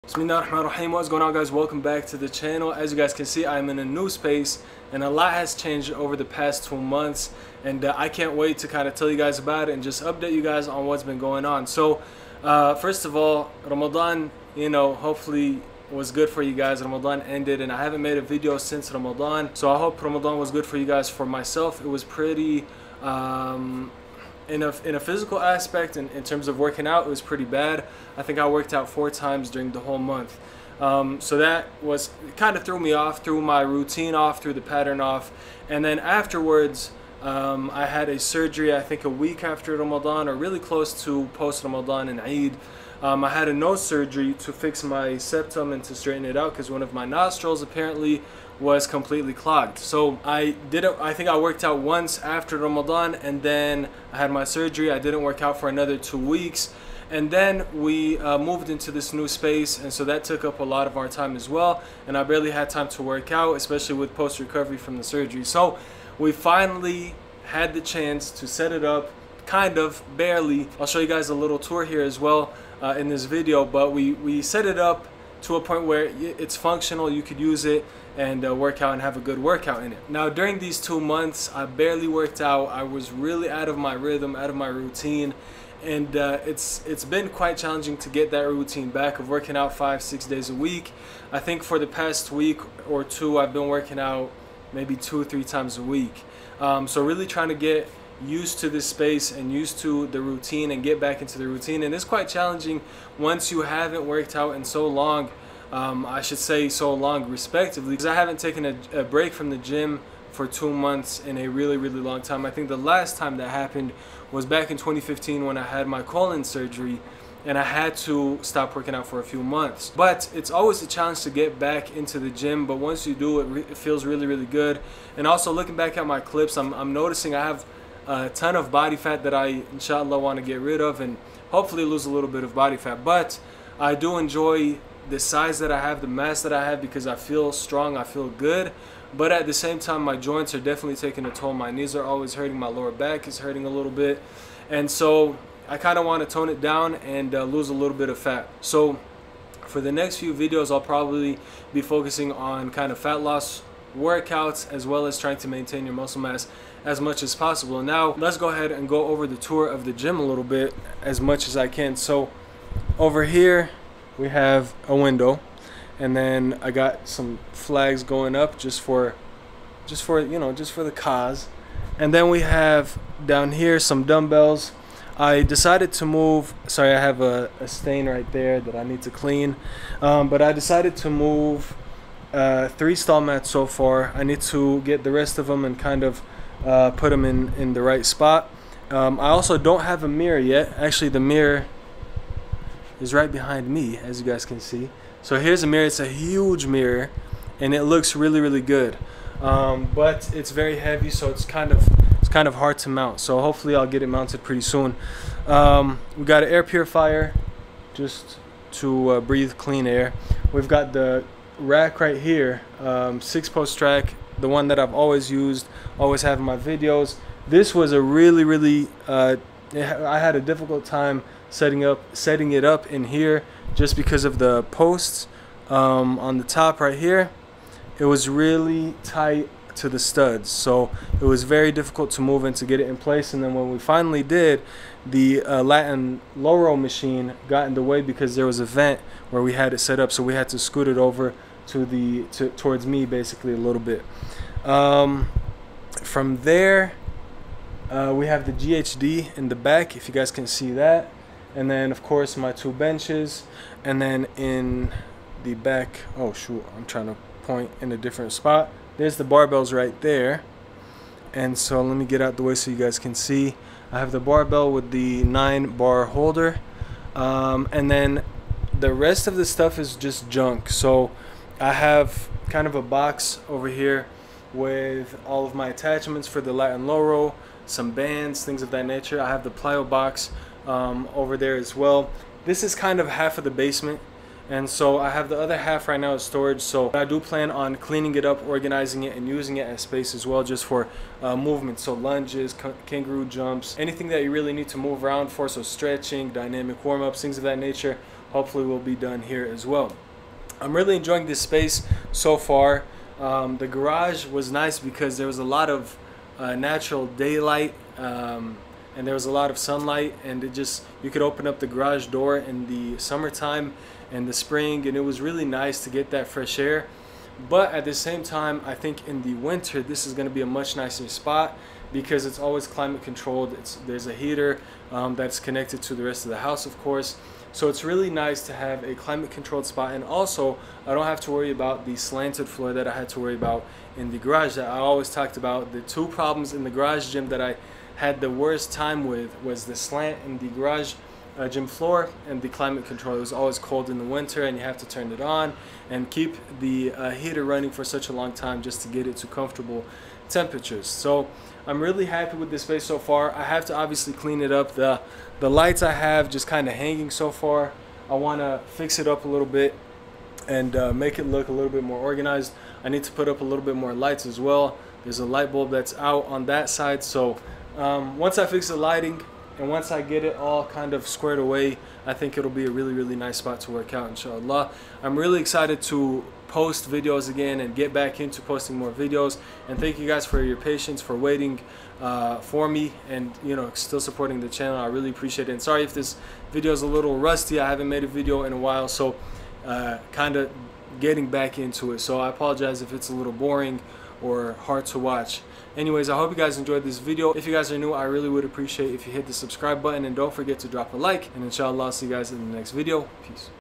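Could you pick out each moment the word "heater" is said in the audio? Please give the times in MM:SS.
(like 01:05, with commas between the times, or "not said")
05:24, 05:47.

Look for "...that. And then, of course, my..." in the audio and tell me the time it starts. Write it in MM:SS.
04:10.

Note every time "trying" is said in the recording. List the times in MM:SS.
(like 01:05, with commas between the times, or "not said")
01:37, 02:35, 04:16.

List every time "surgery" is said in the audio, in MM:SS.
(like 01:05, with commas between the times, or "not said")
00:38, 00:43, 00:54, 01:05, 01:56.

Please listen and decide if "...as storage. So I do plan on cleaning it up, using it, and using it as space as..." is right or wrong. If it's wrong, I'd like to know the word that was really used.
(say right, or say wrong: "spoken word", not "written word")
wrong: "organizing", not "using".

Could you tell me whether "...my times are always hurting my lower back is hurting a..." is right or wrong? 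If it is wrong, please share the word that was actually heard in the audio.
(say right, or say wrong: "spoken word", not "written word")
wrong: "knees", not "times".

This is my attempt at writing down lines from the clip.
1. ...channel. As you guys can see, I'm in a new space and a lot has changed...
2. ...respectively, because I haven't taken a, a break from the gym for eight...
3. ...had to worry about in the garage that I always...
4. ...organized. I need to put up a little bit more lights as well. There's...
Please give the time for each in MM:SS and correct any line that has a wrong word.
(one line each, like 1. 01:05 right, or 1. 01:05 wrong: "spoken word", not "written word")
1. 00:02 right
2. 01:47 wrong: "two", not "eight"
3. 05:32 right
4. 06:01 right.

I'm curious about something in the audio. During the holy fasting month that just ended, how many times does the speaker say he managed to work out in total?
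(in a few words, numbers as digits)
4.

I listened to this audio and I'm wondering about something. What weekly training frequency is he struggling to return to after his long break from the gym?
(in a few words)
5 or 6 days a week.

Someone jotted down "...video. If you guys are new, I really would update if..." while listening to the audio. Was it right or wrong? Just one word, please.
wrong.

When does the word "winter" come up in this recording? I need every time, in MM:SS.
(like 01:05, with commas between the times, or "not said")
05:19, 05:44.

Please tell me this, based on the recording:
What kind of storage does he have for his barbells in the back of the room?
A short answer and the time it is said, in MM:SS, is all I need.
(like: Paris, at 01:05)
Nine bar holder, at 04:25.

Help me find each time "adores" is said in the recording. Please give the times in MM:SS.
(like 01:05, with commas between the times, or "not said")
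not said.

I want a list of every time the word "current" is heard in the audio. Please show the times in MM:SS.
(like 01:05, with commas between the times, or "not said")
not said.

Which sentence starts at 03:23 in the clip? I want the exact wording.
So hopefully, I'll get it mounted pretty soon.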